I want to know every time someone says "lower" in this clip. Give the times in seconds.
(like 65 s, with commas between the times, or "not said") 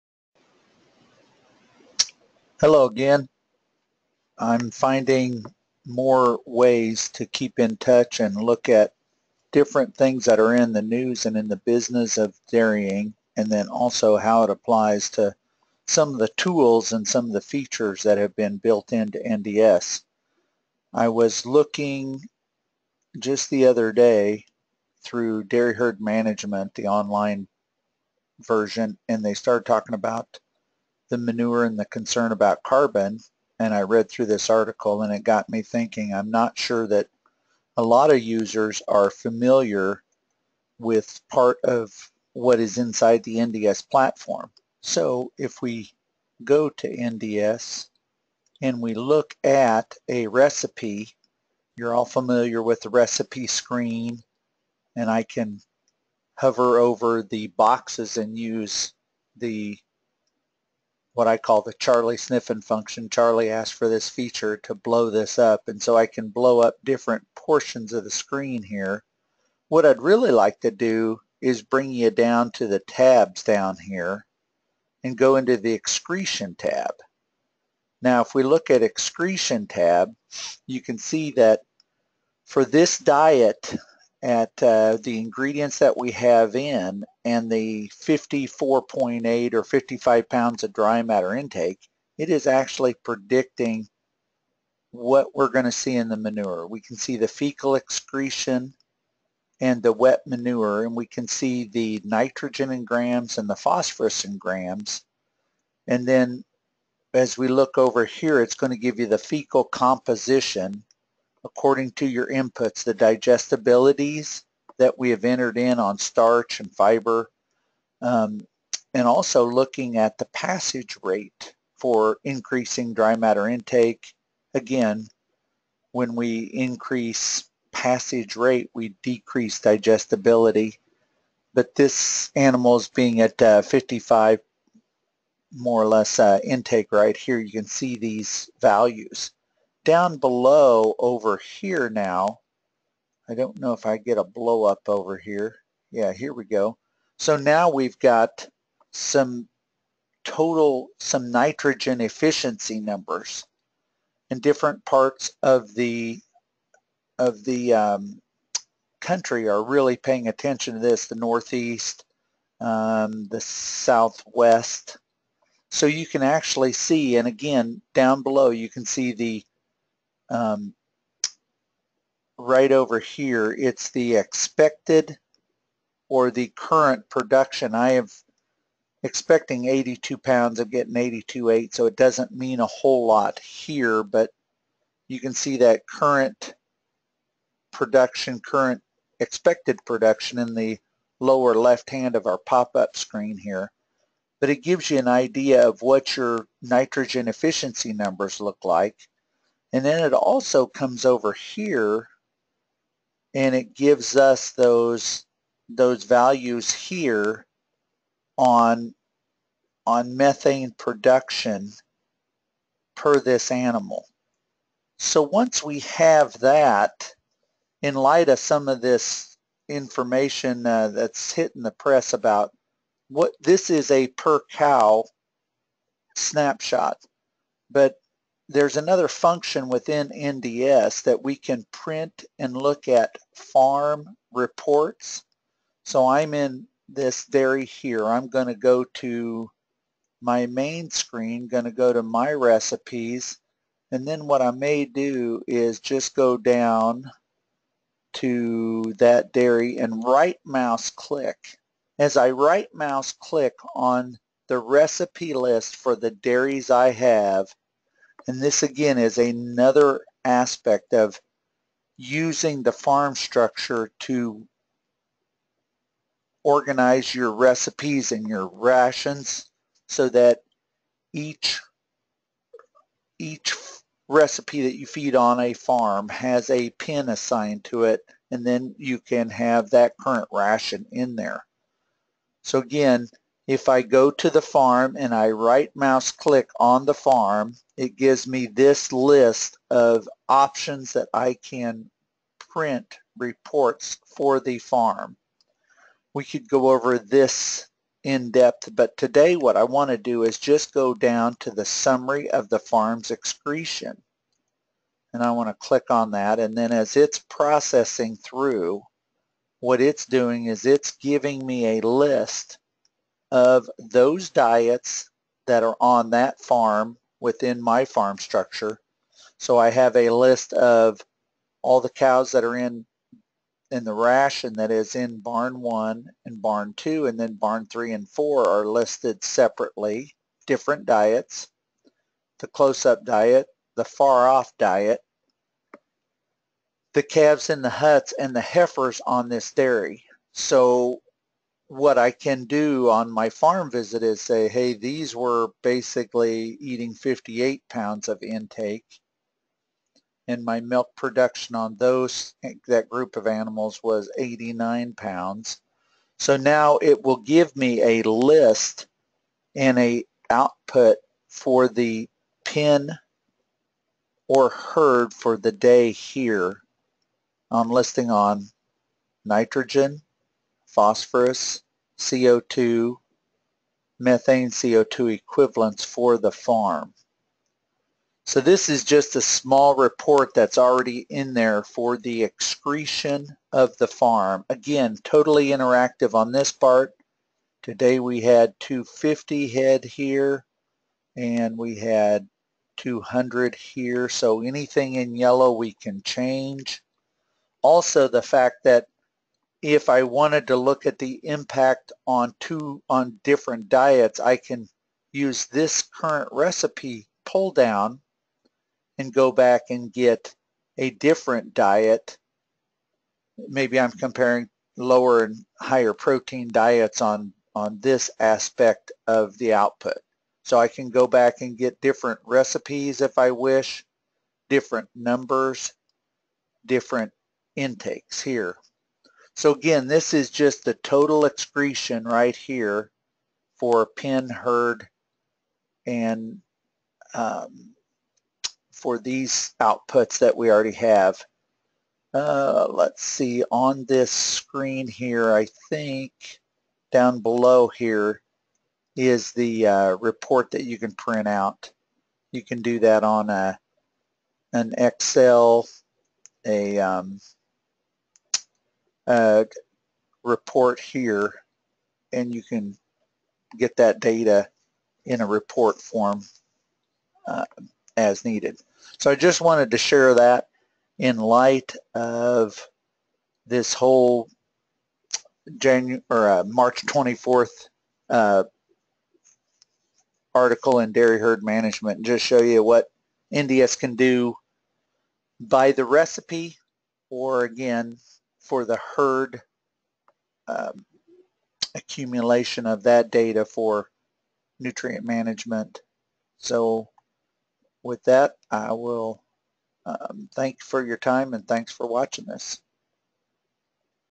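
191 s, 414 s.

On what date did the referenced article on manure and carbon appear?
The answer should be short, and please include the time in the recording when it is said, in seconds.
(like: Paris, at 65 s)
March 24th, at 476 s.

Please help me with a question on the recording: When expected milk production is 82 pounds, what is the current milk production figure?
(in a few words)
82.8 pounds.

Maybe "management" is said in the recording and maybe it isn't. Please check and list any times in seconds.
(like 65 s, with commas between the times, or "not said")
25 s, 481 s, 495 s.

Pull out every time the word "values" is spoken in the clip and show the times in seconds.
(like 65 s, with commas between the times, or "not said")
138 s, 206 s.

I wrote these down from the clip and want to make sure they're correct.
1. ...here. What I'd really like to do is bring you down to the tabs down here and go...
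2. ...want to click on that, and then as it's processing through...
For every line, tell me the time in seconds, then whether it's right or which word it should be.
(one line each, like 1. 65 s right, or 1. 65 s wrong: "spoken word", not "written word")
1. 68 s right
2. 305 s right.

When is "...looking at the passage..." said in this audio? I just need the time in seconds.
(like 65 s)
119 s.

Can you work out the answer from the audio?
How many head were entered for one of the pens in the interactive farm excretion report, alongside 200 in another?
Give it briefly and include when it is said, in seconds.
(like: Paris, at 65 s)
250, at 388 s.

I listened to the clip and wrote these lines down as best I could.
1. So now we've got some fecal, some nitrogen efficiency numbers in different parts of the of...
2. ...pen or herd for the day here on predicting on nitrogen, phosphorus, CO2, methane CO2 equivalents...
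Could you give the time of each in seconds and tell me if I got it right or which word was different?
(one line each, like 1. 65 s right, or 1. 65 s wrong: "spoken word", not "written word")
1. 147 s wrong: "total", not "fecal"
2. 362 s wrong: "listing", not "predicting".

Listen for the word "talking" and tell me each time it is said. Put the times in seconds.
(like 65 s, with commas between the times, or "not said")
29 s.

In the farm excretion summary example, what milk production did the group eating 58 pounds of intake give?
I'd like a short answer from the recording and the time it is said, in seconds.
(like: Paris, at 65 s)
89 pounds, at 354 s.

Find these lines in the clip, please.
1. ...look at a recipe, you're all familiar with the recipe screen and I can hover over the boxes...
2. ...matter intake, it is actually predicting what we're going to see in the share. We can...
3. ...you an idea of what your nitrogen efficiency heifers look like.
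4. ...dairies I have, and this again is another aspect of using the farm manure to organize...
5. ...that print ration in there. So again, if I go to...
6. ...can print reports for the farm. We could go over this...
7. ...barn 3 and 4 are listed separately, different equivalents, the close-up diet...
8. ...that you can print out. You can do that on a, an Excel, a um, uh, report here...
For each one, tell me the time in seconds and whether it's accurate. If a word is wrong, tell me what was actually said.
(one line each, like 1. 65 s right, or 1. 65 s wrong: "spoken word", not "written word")
1. 48 s right
2. 91 s wrong: "manure", not "share"
3. 194 s wrong: "numbers", not "heifers"
4. 256 s wrong: "structure", not "manure"
5. 279 s wrong: "current", not "print"
6. 291 s right
7. 327 s wrong: "diets", not "equivalents"
8. 450 s right.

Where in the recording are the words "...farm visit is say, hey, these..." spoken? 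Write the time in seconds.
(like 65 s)
343 s.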